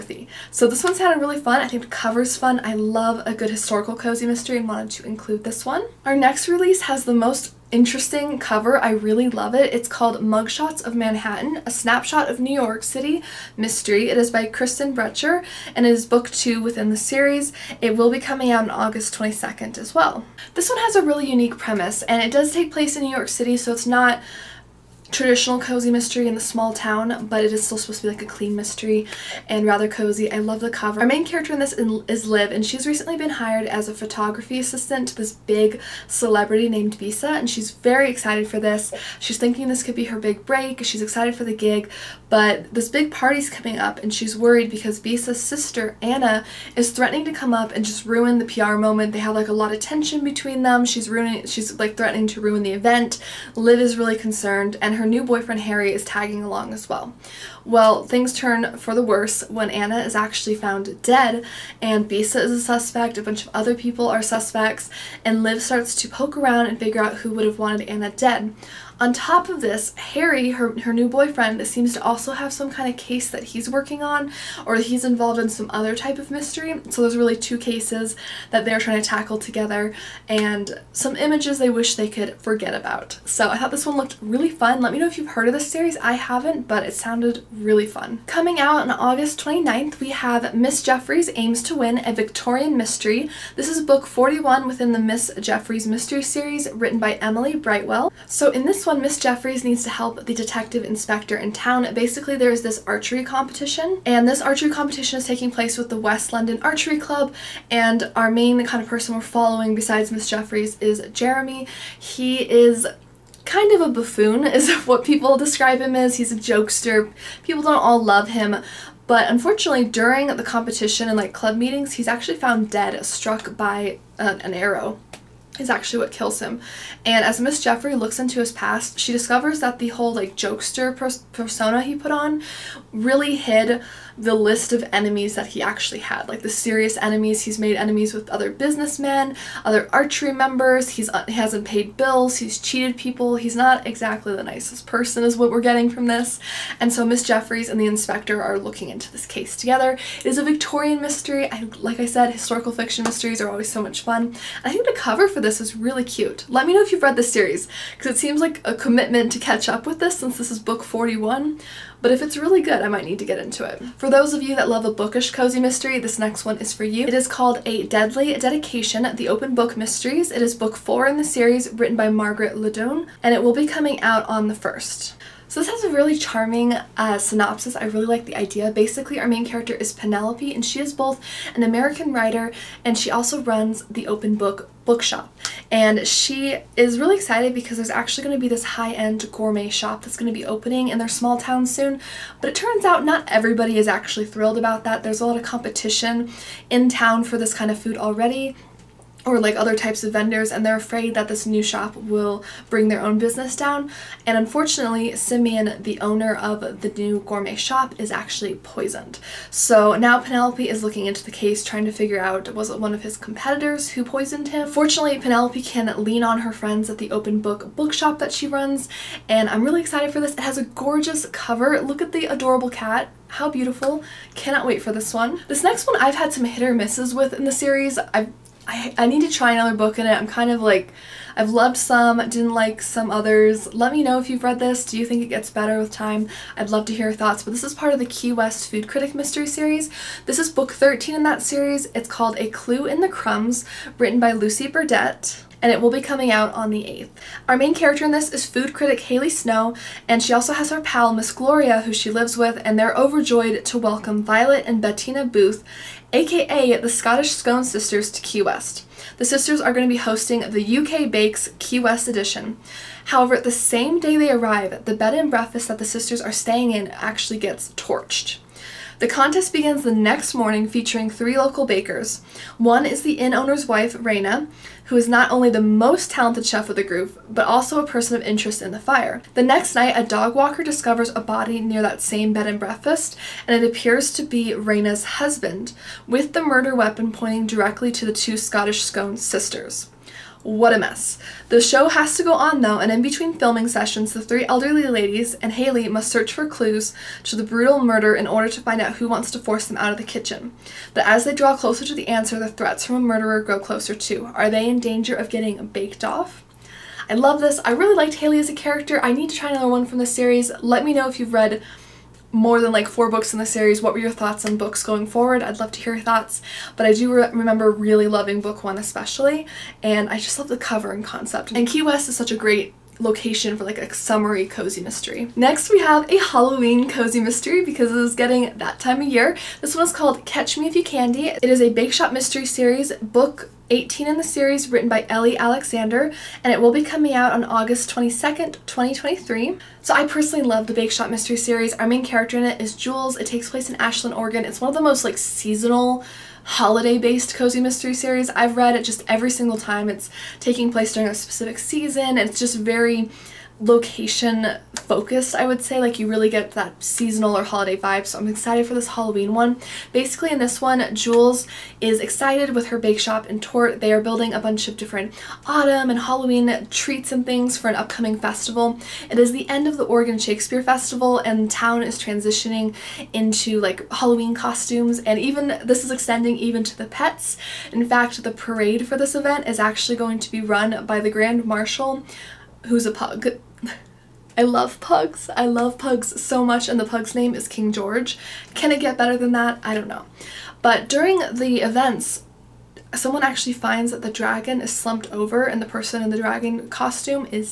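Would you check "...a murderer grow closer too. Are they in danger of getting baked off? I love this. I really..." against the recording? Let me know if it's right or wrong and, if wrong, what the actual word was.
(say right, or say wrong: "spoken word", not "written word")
right.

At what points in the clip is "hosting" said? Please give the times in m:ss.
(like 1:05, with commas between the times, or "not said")
4:19.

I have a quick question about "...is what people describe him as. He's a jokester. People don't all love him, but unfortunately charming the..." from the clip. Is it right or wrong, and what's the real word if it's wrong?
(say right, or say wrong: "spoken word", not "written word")
wrong: "during", not "charming".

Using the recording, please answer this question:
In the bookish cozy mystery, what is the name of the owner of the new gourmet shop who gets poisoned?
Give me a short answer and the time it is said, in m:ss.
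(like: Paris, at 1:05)
Simeon, at 3:25.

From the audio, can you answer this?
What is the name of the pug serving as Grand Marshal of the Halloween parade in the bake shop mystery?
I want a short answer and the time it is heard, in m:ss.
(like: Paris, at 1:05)
King George, at 6:27.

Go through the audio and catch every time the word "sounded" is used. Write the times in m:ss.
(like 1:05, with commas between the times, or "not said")
0:00, 1:26.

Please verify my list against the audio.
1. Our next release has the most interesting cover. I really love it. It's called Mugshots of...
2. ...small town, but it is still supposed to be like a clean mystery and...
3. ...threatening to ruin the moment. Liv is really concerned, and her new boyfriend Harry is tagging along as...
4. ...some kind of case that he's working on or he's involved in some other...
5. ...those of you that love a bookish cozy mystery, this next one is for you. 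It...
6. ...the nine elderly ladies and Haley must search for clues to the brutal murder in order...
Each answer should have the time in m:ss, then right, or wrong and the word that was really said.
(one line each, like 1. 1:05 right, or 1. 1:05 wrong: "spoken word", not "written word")
1. 0:06 right
2. 0:26 right
3. 0:51 wrong: "event", not "moment"
4. 1:12 right
5. 2:44 right
6. 4:54 wrong: "three", not "nine".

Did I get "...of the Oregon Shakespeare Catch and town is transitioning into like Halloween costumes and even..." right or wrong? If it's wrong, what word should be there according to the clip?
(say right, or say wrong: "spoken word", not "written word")
wrong: "Festival", not "Catch".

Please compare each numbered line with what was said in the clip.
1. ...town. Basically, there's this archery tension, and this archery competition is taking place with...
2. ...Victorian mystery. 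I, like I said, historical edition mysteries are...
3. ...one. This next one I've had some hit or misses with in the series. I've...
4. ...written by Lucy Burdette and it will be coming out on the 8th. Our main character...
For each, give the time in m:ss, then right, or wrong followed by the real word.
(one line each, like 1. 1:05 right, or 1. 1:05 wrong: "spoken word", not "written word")
1. 1:41 wrong: "competition", not "tension"
2. 2:30 wrong: "fiction", not "edition"
3. 3:45 right
4. 4:03 right.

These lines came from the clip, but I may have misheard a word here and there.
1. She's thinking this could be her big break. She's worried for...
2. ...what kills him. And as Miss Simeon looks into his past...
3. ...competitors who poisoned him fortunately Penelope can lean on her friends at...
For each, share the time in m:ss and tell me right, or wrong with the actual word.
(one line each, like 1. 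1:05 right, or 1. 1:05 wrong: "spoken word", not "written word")
1. 0:39 wrong: "excited", not "worried"
2. 2:05 wrong: "Jeffrey", not "Simeon"
3. 3:33 right.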